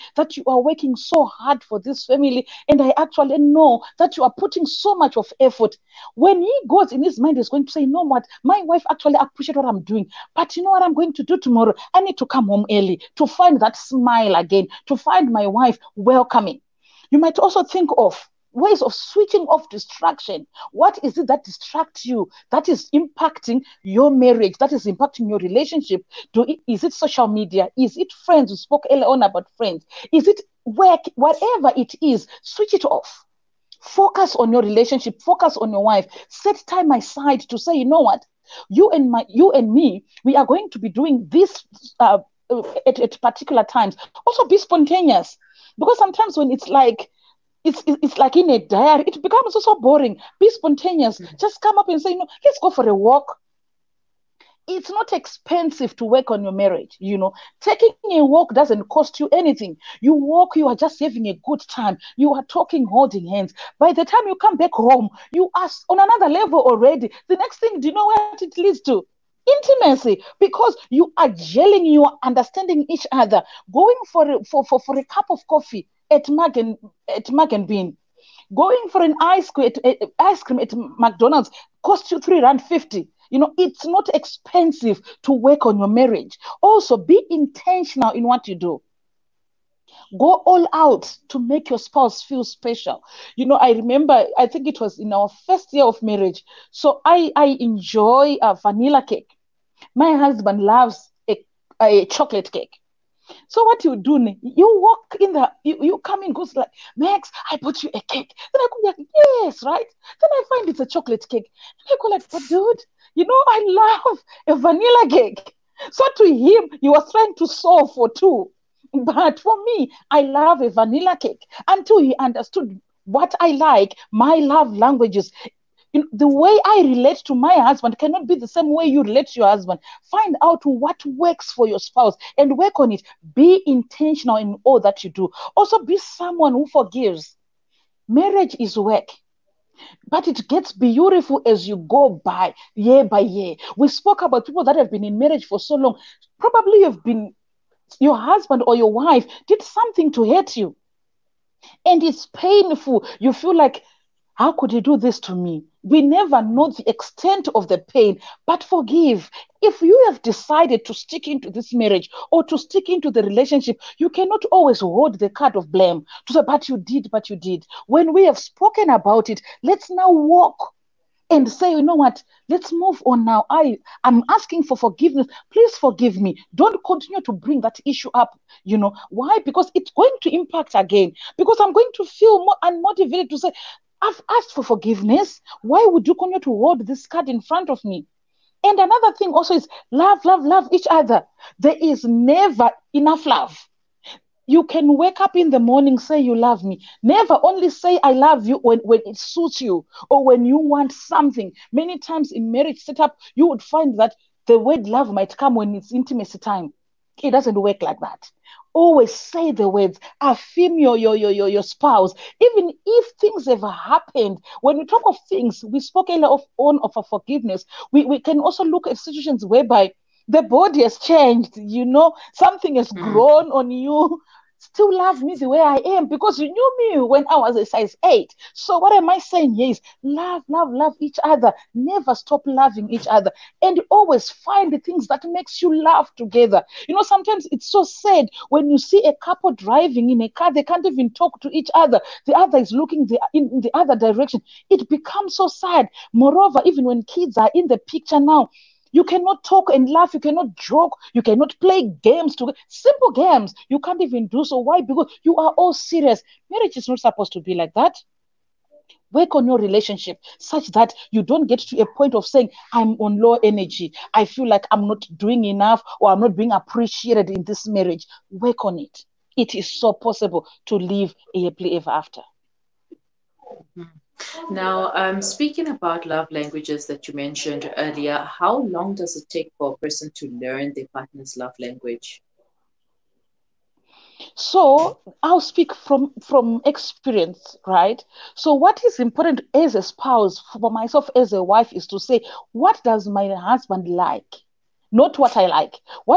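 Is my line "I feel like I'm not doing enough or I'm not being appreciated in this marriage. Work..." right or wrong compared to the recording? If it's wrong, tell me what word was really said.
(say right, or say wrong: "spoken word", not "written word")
right.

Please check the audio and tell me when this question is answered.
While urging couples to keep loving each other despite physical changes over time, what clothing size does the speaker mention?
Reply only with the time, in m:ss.
3:47.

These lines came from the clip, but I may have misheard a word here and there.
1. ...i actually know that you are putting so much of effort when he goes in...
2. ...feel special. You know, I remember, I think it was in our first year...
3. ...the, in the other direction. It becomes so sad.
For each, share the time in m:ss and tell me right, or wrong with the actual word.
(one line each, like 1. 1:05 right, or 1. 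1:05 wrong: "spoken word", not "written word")
1. 0:02 right
2. 1:32 right
3. 4:03 right.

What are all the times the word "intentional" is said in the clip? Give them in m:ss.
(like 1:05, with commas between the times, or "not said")
1:27, 2:13.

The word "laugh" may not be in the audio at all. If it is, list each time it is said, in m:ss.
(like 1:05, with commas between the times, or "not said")
3:55, 4:09.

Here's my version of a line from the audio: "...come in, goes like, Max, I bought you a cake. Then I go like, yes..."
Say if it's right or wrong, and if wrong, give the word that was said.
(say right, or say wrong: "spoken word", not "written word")
right.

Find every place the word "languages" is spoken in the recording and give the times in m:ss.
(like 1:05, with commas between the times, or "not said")
2:04, 4:36, 4:41.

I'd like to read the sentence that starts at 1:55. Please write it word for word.
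So to him, he was trying to solve for two.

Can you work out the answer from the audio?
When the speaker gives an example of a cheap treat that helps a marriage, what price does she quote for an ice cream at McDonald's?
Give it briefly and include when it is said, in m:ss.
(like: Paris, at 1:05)
R3.50, at 1:22.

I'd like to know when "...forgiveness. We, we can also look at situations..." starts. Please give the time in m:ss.
3:37.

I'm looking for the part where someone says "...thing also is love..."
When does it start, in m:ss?
3:09.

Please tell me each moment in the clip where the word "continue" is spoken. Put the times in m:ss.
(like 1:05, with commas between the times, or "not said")
2:56, 3:06.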